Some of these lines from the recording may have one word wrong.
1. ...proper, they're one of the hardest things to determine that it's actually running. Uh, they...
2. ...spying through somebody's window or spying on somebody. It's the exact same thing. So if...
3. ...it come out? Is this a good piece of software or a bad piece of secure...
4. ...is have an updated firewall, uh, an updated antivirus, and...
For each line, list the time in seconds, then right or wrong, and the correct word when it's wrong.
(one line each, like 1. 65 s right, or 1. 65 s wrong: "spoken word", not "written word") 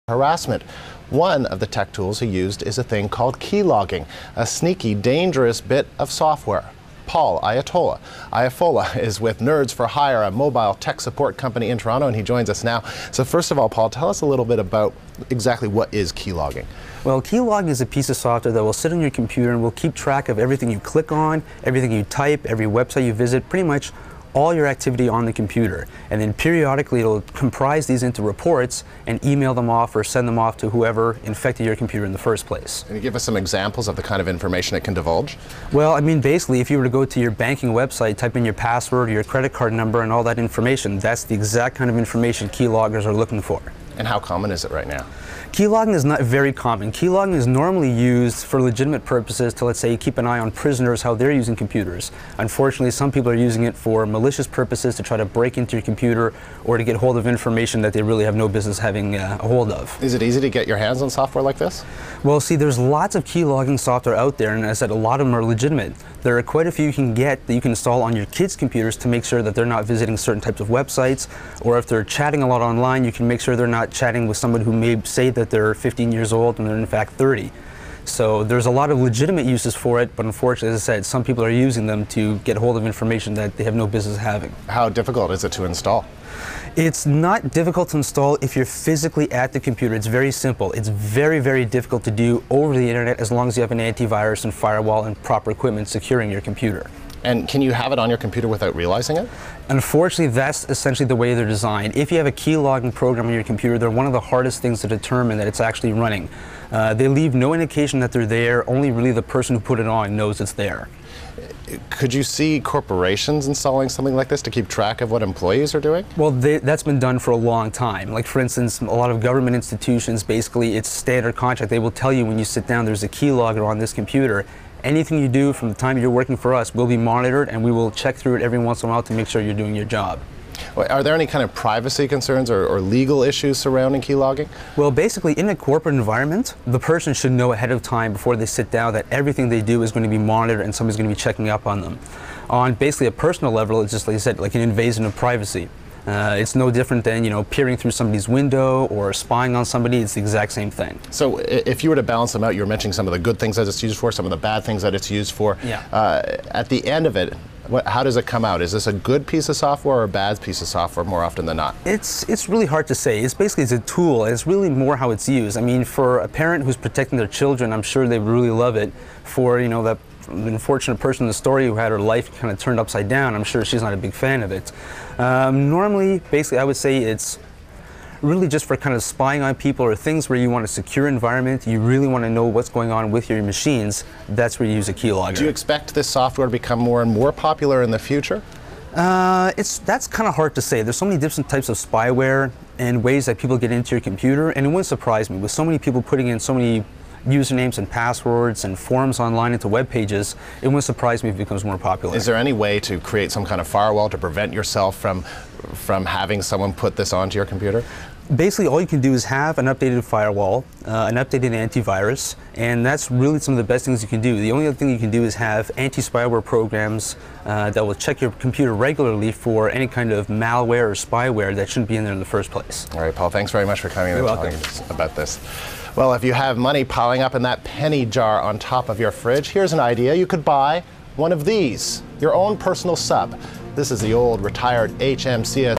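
1. 103 s wrong: "computer", not "proper"
2. 147 s wrong: "peering", not "spying"
3. 158 s wrong: "software", not "secure"
4. 209 s right.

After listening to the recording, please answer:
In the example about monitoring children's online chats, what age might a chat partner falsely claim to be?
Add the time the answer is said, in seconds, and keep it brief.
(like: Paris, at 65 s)
15, at 75 s.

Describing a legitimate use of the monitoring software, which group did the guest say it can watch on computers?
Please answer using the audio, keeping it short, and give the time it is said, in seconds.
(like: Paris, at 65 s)
prisoners, at 50 s.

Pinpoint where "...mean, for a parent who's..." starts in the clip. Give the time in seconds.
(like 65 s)
165 s.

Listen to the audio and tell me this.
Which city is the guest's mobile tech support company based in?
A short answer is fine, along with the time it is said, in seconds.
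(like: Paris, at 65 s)
Toronto, at 11 s.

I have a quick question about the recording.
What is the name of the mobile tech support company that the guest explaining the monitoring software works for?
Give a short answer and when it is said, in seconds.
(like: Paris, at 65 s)
Nerds for Hire, at 9 s.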